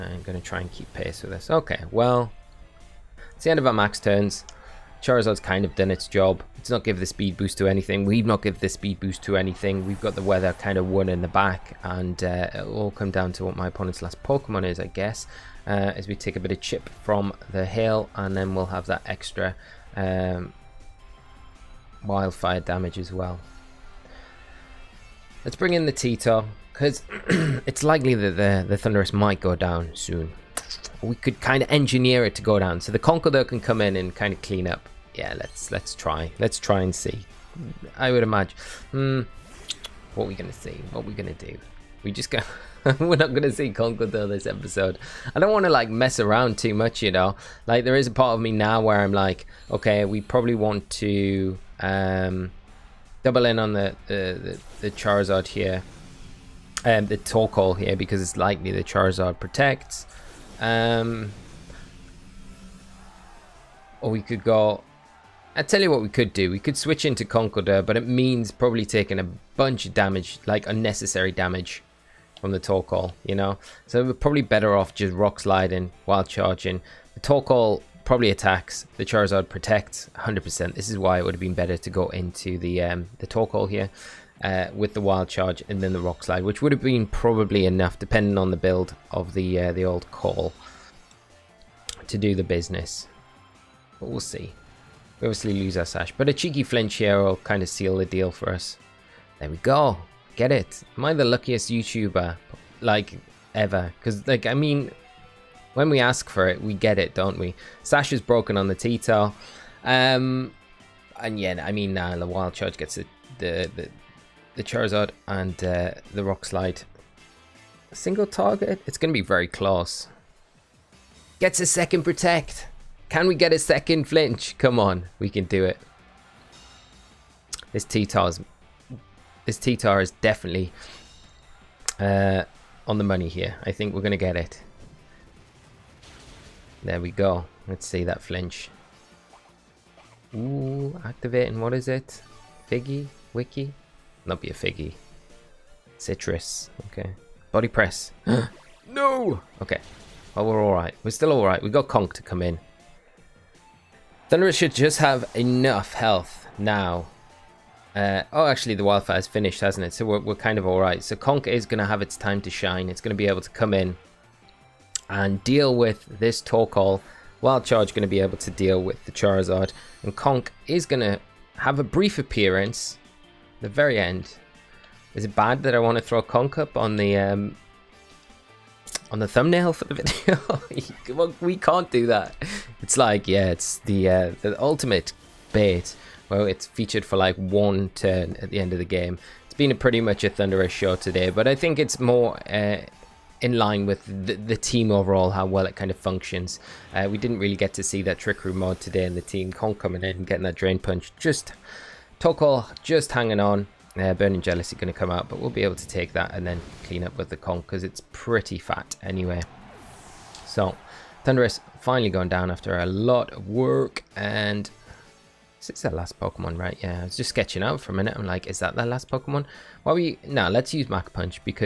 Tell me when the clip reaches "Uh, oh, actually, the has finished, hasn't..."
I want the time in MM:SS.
02:37.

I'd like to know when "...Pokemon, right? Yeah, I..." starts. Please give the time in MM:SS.
03:36.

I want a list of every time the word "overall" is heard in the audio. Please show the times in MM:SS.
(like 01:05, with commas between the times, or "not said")
03:14.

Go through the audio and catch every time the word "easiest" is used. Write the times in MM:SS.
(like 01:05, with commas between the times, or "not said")
not said.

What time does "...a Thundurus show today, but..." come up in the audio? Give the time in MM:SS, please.
03:10.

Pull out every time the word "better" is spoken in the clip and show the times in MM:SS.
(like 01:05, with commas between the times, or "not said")
01:14, 01:21.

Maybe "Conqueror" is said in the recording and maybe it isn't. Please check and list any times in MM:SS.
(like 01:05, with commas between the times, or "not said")
00:32, 00:43.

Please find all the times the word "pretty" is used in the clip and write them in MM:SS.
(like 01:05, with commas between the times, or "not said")
03:09, 03:28.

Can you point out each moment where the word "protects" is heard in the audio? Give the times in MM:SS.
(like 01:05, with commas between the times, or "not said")
00:59, 01:19, 02:02.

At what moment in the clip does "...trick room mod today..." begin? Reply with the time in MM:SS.
03:18.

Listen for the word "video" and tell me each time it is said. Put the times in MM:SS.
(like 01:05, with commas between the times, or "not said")
02:59.